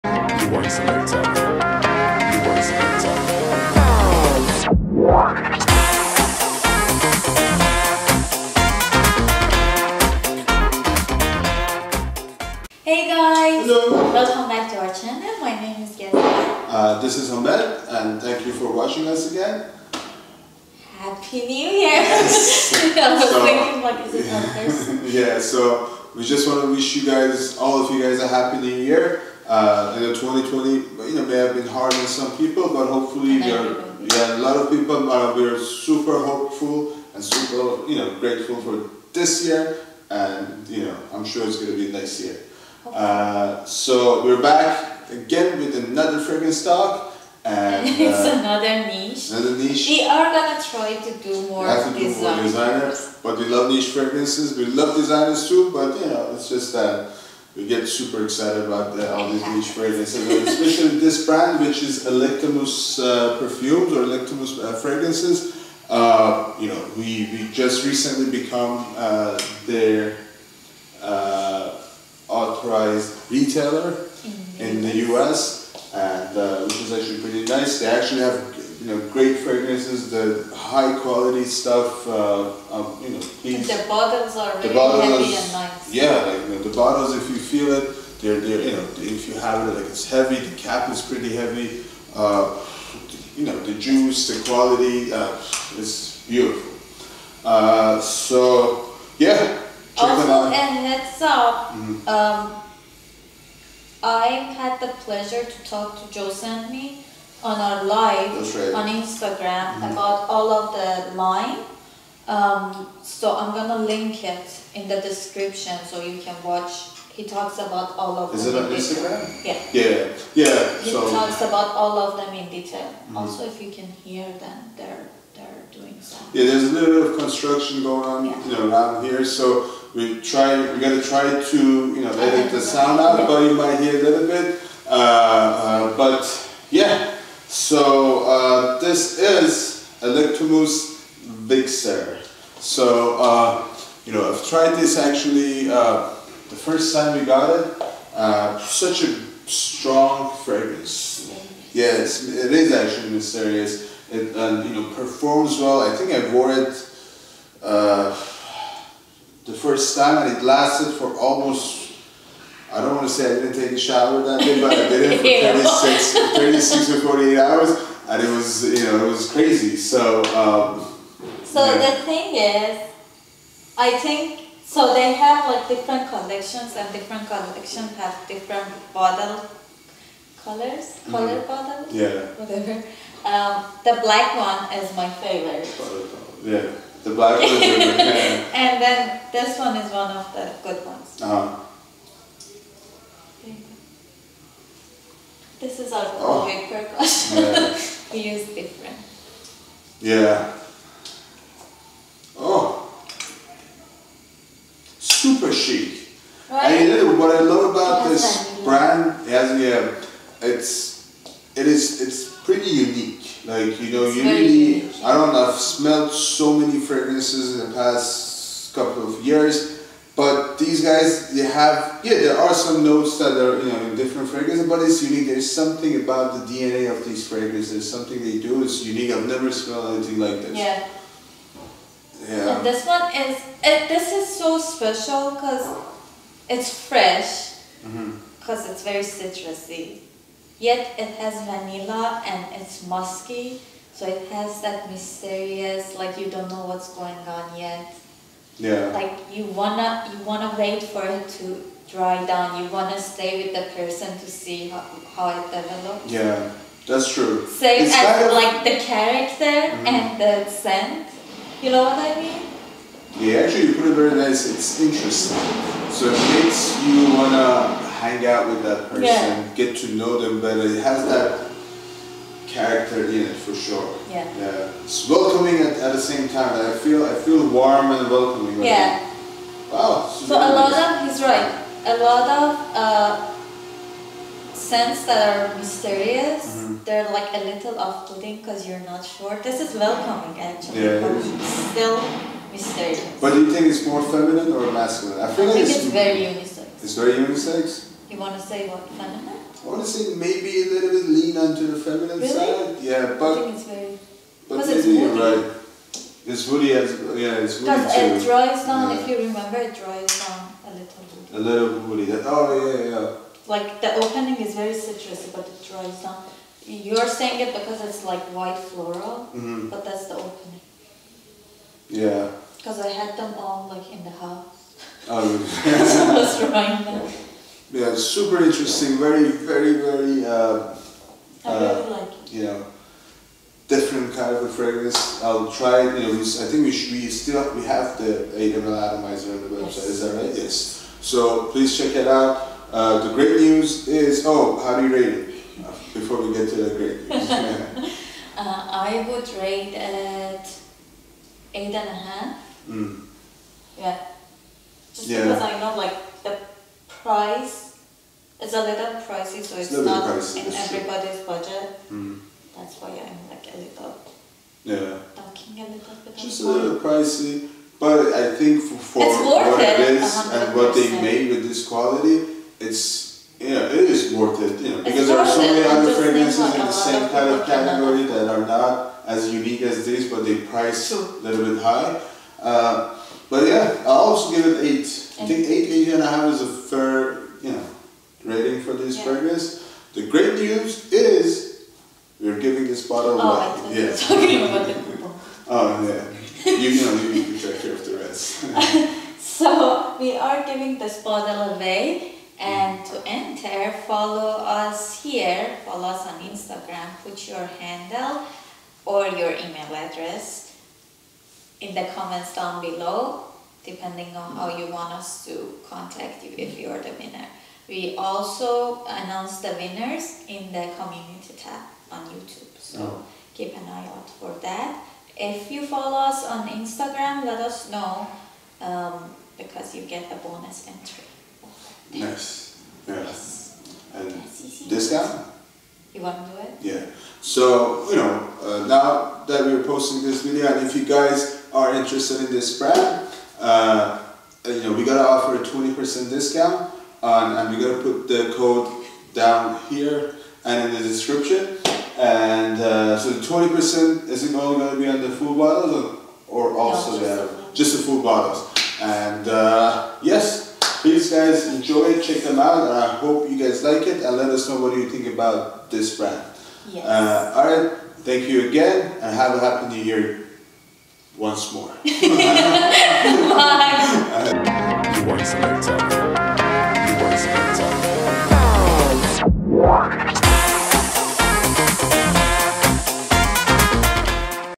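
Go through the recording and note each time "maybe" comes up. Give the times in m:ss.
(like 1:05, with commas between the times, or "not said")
5:00, 5:04.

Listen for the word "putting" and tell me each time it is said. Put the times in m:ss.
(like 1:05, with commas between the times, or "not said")
4:47.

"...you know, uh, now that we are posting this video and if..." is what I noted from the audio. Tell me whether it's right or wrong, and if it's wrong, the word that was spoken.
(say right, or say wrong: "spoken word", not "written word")
right.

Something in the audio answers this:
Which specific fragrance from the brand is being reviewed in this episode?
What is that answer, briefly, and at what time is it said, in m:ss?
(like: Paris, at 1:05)
Vixere, at 2:20.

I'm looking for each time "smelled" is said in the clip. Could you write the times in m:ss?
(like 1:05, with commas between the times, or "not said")
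3:35, 3:49.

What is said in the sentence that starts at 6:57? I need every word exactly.
We also announce the winners in the community tab on YouTube, so oh.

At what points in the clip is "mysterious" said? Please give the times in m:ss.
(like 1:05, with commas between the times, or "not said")
2:33, 4:04, 4:45, 4:52.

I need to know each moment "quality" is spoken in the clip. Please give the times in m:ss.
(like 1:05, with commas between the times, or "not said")
1:21, 1:34, 6:11.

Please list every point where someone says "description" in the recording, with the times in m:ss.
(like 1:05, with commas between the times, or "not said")
1:55, 7:30.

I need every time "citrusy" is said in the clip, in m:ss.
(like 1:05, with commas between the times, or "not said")
3:59, 5:14.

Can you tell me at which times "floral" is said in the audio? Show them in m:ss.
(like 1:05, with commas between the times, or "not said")
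5:18.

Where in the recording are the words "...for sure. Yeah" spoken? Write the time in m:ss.
4:33.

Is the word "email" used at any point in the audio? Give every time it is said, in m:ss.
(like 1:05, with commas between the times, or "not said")
6:49.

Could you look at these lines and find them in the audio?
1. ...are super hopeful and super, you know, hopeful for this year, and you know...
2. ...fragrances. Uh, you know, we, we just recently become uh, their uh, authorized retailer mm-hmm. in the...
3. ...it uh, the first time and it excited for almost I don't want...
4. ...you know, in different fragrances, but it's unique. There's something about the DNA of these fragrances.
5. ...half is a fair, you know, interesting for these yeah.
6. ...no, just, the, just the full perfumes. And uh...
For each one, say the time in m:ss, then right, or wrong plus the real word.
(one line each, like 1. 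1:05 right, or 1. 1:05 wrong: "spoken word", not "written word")
1. 0:35 wrong: "grateful", not "hopeful"
2. 1:04 right
3. 2:36 wrong: "lasted", not "excited"
4. 3:43 right
5. 6:26 wrong: "rating", not "interesting"
6. 7:36 wrong: "bottles", not "perfumes".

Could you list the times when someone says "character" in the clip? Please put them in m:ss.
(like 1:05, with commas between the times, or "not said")
4:18, 4:32.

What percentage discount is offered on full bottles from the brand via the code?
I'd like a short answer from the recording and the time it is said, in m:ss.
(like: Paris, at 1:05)
20%, at 7:25.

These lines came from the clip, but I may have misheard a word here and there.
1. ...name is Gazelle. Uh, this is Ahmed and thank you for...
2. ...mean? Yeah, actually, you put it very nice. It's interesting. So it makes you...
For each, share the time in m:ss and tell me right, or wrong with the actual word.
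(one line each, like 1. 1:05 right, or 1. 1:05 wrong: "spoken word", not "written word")
1. 0:15 right
2. 4:22 right.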